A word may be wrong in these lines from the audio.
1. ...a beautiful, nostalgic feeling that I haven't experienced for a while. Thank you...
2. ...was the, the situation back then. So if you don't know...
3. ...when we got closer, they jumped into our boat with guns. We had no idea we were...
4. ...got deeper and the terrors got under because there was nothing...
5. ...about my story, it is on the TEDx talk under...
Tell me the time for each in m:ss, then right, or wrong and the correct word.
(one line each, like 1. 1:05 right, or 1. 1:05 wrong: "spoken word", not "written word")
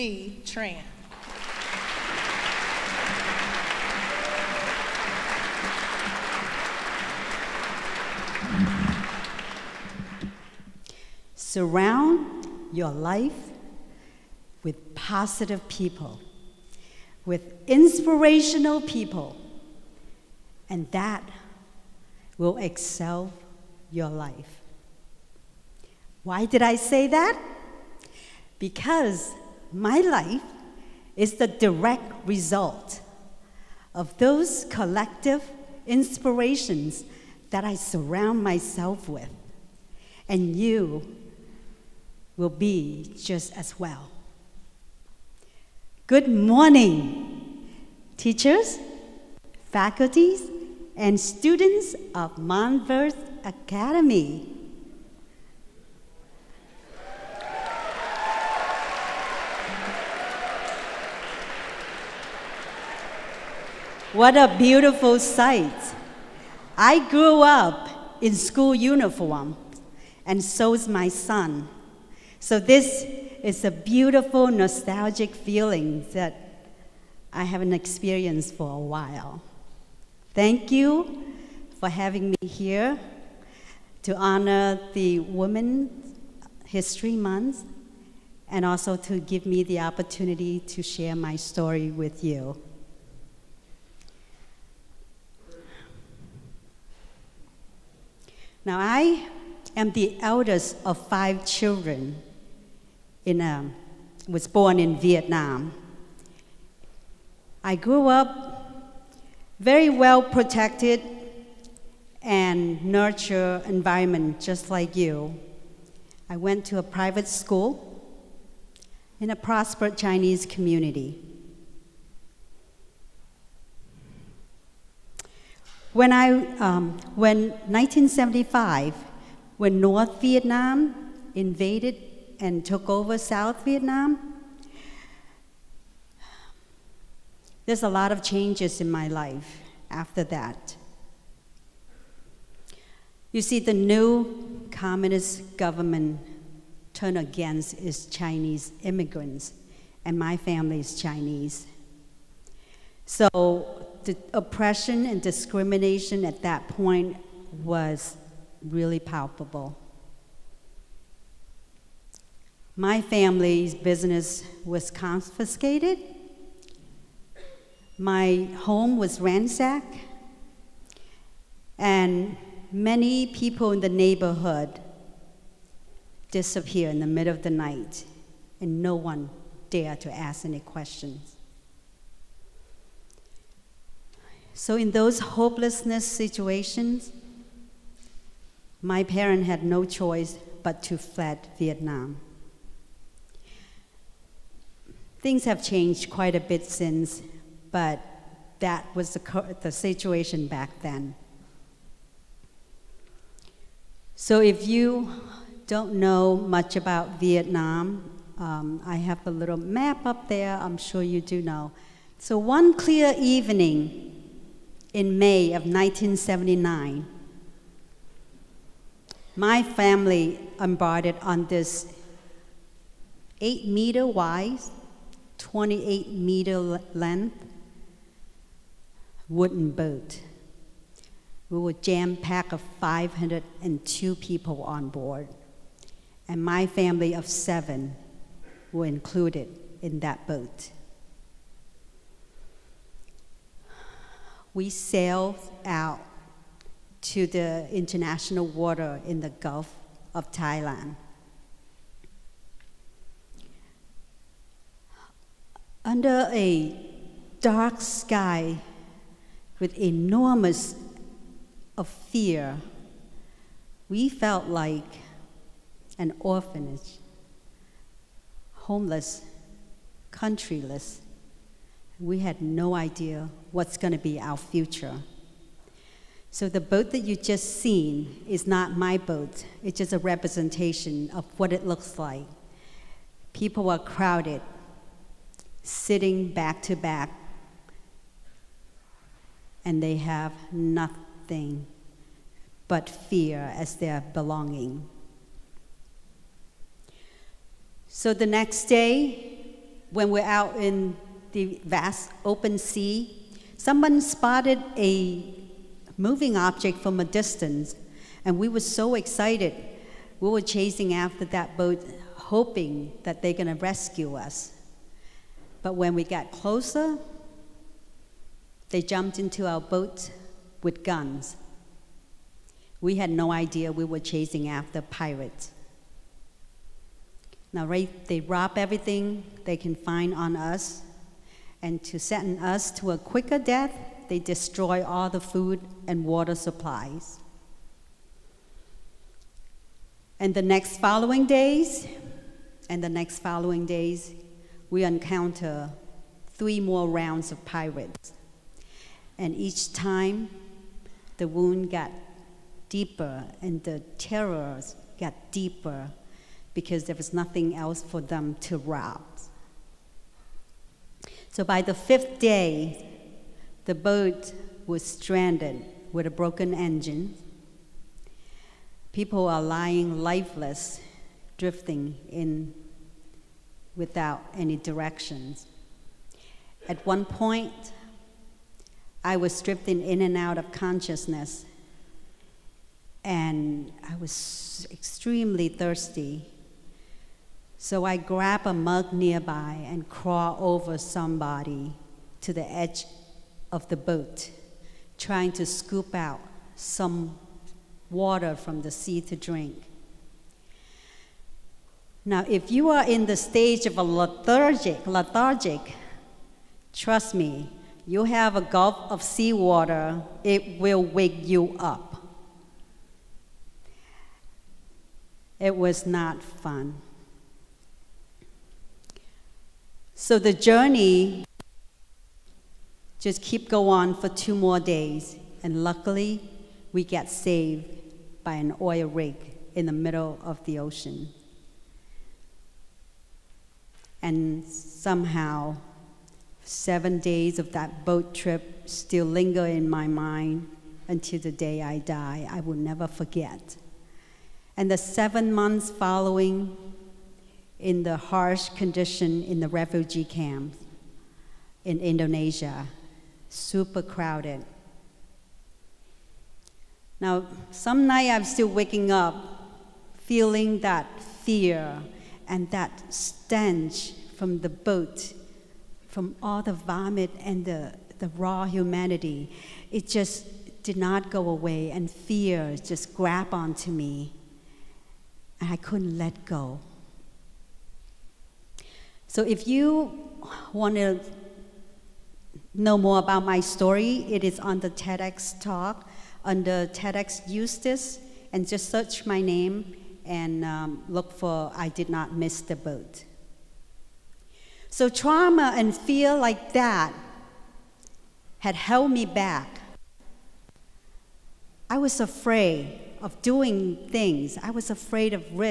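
1. 1:13 right
2. 3:18 right
3. 5:15 right
4. 5:51 wrong: "deeper", not "under"
5. 8:02 right.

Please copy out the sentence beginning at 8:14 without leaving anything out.
So trauma and fear like that had held me back.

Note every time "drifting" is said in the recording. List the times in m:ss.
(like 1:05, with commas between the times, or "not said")
6:11, 6:19.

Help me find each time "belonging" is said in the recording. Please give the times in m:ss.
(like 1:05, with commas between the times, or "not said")
4:54.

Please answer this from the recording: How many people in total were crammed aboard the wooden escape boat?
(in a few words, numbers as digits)
502.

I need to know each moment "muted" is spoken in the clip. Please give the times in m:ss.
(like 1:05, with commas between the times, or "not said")
not said.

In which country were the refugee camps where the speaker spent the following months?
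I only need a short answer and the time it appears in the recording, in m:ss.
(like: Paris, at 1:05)
Indonesia, at 7:31.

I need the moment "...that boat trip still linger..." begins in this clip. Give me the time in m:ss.
7:17.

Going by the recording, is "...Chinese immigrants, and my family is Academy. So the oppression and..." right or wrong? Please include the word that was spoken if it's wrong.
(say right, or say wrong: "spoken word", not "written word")
wrong: "Chinese", not "Academy".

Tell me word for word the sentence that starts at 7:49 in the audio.
It just did not go away, and fear just grabbed onto me, and I couldn't let go.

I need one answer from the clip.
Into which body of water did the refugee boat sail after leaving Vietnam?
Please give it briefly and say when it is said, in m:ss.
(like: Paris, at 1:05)
Gulf of Thailand, at 4:09.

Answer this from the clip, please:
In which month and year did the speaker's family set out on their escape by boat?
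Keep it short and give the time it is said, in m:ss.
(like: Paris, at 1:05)
May 1979, at 3:35.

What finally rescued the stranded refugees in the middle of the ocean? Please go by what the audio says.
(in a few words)
An oil rig.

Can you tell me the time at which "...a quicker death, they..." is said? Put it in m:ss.
5:32.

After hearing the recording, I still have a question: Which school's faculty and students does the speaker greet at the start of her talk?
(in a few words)
Montverde Academy.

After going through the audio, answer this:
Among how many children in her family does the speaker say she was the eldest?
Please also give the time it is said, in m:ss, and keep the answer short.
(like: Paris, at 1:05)
5, at 1:41.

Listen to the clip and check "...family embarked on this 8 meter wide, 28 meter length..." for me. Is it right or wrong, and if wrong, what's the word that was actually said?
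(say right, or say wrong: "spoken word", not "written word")
right.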